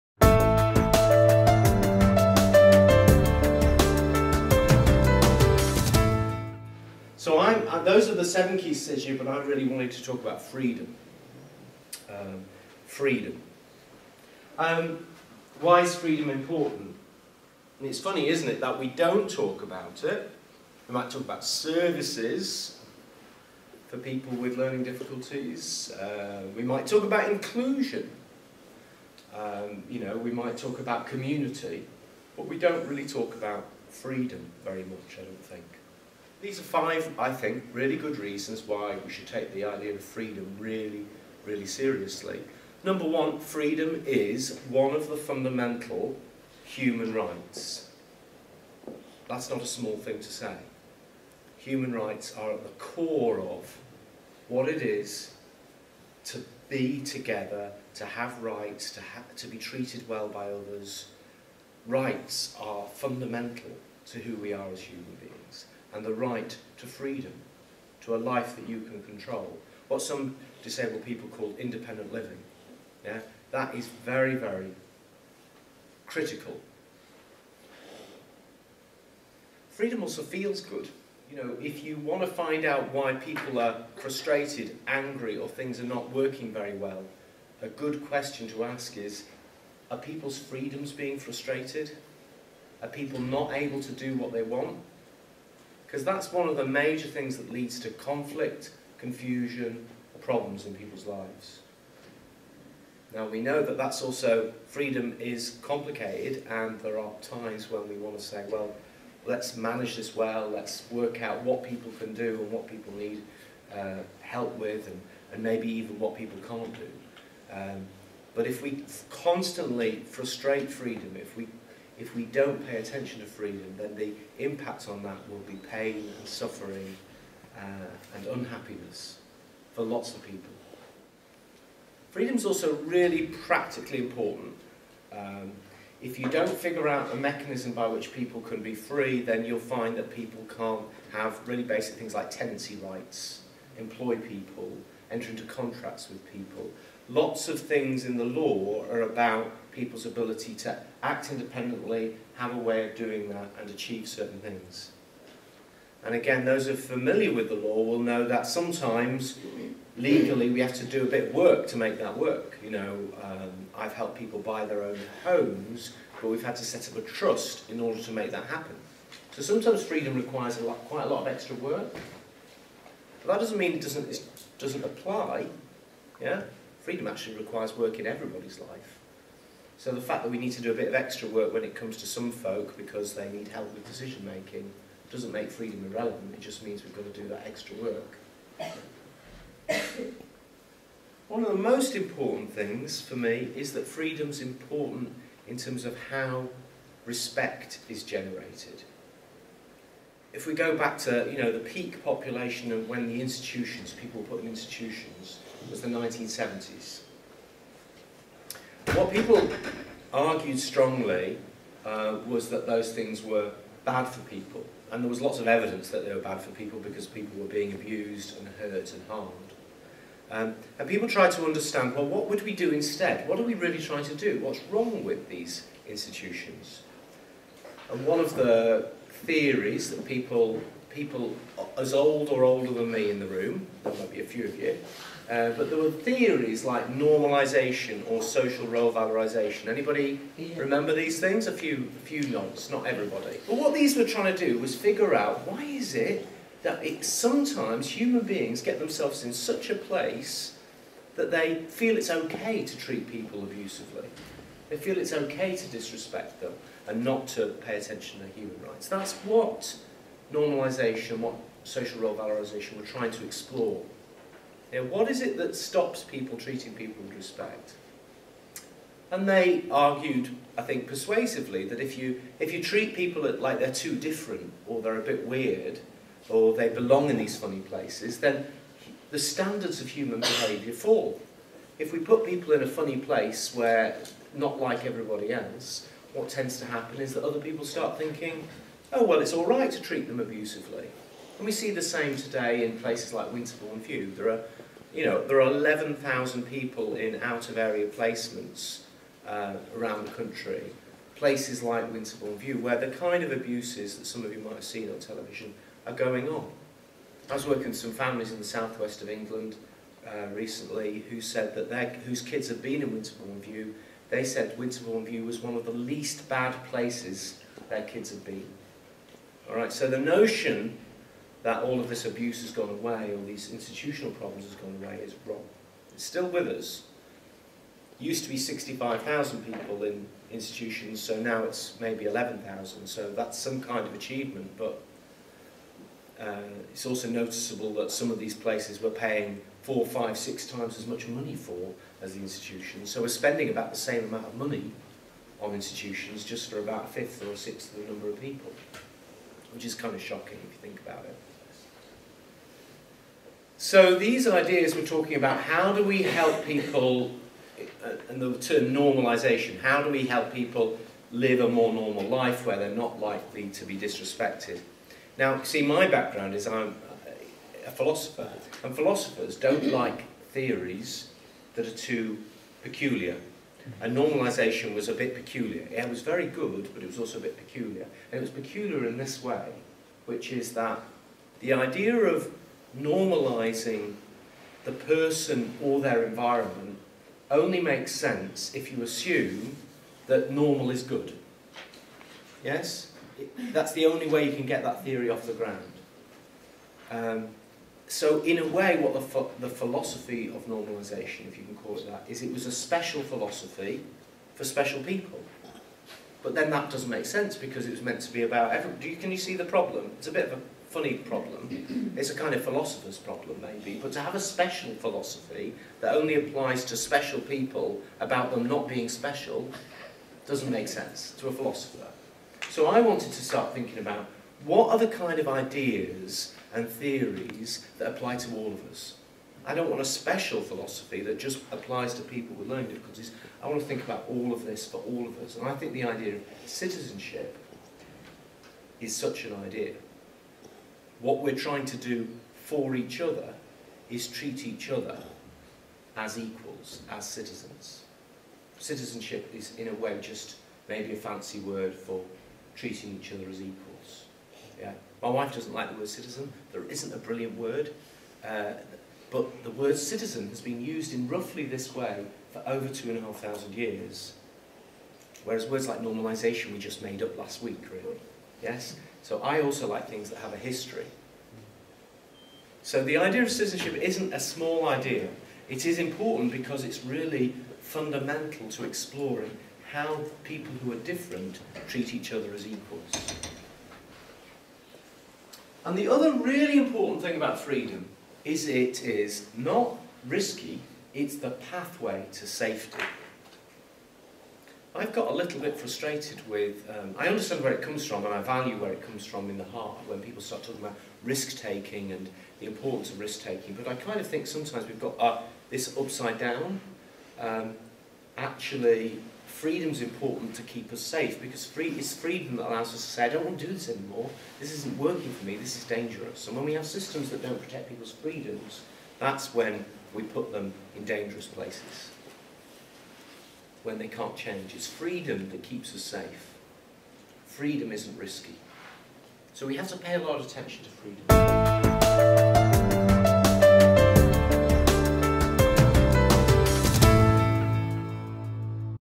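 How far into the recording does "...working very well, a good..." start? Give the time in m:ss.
1:26.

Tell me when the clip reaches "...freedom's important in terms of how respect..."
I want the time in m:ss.
3:13.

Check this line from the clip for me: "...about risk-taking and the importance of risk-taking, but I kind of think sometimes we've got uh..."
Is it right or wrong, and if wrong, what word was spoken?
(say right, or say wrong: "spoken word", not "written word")
right.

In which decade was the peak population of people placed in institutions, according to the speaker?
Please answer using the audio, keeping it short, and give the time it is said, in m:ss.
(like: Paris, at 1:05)
1970s, at 3:25.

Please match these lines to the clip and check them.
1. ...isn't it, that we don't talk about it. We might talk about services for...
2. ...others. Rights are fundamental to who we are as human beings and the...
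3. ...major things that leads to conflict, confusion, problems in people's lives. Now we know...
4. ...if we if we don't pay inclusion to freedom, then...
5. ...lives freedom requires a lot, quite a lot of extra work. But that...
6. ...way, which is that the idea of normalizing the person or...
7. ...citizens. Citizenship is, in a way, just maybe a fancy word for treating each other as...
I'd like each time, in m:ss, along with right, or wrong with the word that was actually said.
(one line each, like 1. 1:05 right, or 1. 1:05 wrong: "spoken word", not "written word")
1. 0:18 right
2. 1:00 right
3. 1:36 right
4. 2:01 wrong: "attention", not "inclusion"
5. 2:49 wrong: "sometimes", not "lives"
6. 6:19 right
7. 7:27 right.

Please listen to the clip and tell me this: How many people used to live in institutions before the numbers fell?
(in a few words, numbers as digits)
65,000.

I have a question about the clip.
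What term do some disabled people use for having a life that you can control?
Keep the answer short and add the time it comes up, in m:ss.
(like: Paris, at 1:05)
independent living, at 1:11.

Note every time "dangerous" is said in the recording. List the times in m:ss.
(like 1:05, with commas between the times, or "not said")
8:35, 8:40.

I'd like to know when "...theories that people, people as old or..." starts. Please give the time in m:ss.
3:49.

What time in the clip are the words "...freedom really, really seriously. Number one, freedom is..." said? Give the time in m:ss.
0:40.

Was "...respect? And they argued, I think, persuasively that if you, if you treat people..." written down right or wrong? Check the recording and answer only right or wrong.
right.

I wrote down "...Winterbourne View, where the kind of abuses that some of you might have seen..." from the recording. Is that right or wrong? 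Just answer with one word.
right.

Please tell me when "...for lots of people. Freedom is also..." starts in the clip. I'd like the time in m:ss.
2:09.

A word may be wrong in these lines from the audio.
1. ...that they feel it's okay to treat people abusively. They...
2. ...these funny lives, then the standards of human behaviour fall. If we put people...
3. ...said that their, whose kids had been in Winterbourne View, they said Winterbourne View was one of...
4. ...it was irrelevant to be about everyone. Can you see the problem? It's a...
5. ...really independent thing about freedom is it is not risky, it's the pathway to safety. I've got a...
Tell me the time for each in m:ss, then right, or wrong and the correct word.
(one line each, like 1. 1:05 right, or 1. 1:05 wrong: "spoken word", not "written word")
1. 4:11 right
2. 4:37 wrong: "places", not "lives"
3. 5:11 right
4. 6:47 wrong: "meant", not "irrelevant"
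5. 8:06 wrong: "important", not "independent".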